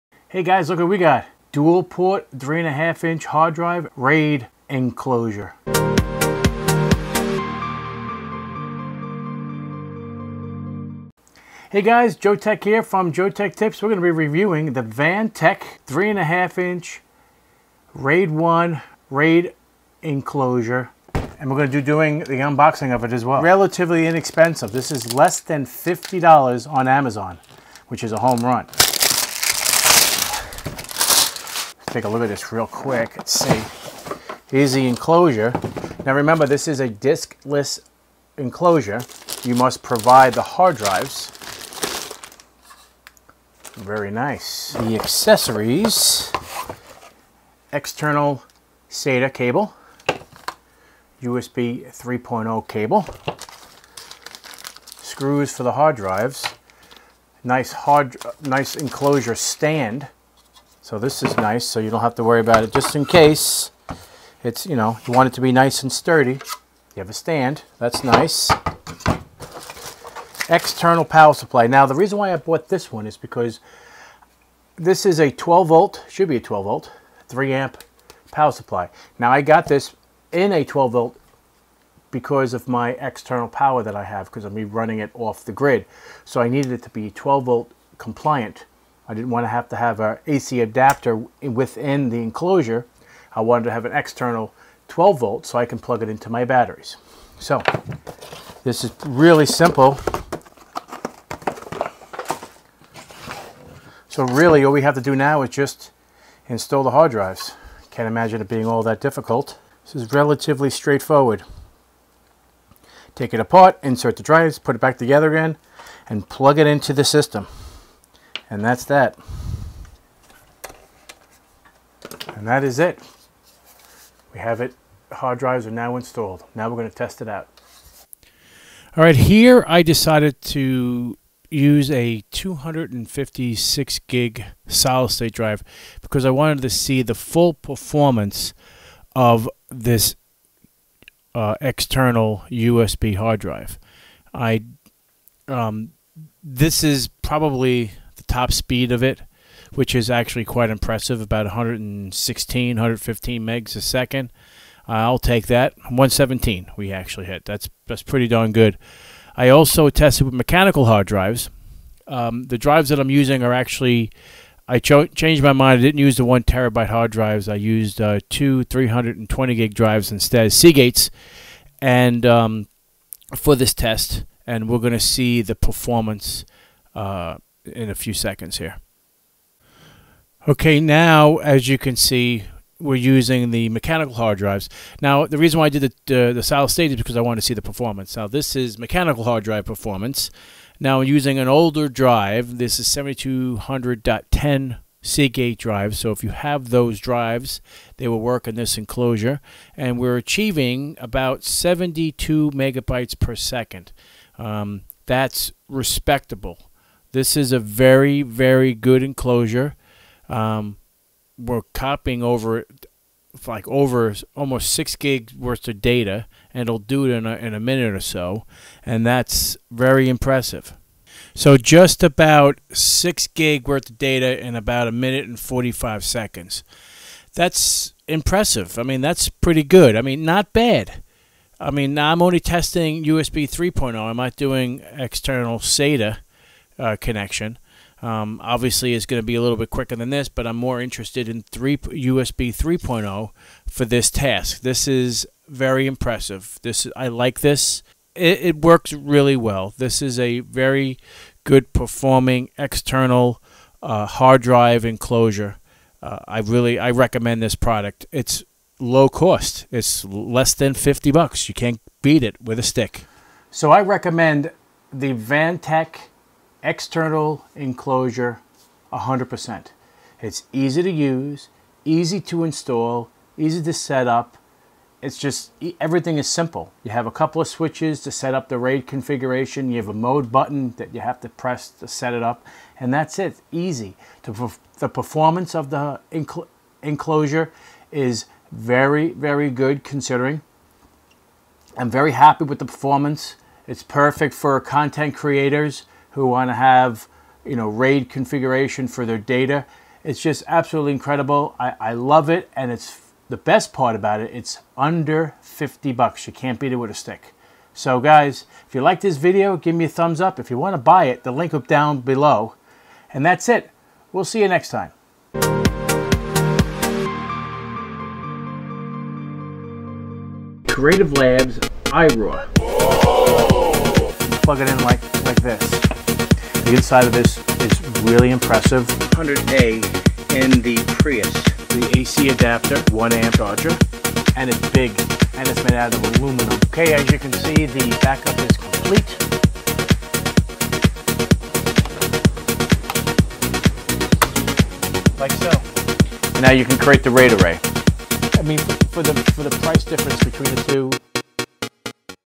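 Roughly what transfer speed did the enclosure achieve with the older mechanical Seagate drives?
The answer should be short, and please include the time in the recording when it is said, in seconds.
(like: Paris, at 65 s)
72 megabytes per second, at 201 s.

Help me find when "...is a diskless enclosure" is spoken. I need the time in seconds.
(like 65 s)
36 s.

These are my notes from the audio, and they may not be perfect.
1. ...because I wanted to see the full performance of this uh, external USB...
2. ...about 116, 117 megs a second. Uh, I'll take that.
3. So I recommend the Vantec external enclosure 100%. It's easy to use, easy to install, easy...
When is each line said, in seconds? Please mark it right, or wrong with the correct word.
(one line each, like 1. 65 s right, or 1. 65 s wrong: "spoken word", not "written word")
1. 136 s right
2. 151 s wrong: "115", not "117"
3. 263 s right.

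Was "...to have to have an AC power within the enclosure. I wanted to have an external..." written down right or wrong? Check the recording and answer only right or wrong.
wrong.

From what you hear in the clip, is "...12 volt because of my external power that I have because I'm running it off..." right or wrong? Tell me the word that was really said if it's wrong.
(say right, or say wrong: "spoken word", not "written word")
right.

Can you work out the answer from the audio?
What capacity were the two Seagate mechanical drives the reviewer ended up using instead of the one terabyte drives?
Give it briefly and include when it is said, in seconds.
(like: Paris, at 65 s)
320 gig, at 168 s.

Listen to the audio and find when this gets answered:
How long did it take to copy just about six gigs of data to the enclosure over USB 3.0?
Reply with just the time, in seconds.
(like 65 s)
224 s.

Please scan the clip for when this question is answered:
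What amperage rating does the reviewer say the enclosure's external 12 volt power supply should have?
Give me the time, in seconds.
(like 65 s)
77 s.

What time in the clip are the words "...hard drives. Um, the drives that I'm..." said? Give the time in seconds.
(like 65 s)
160 s.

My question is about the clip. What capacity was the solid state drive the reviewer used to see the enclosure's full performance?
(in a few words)
256 gig.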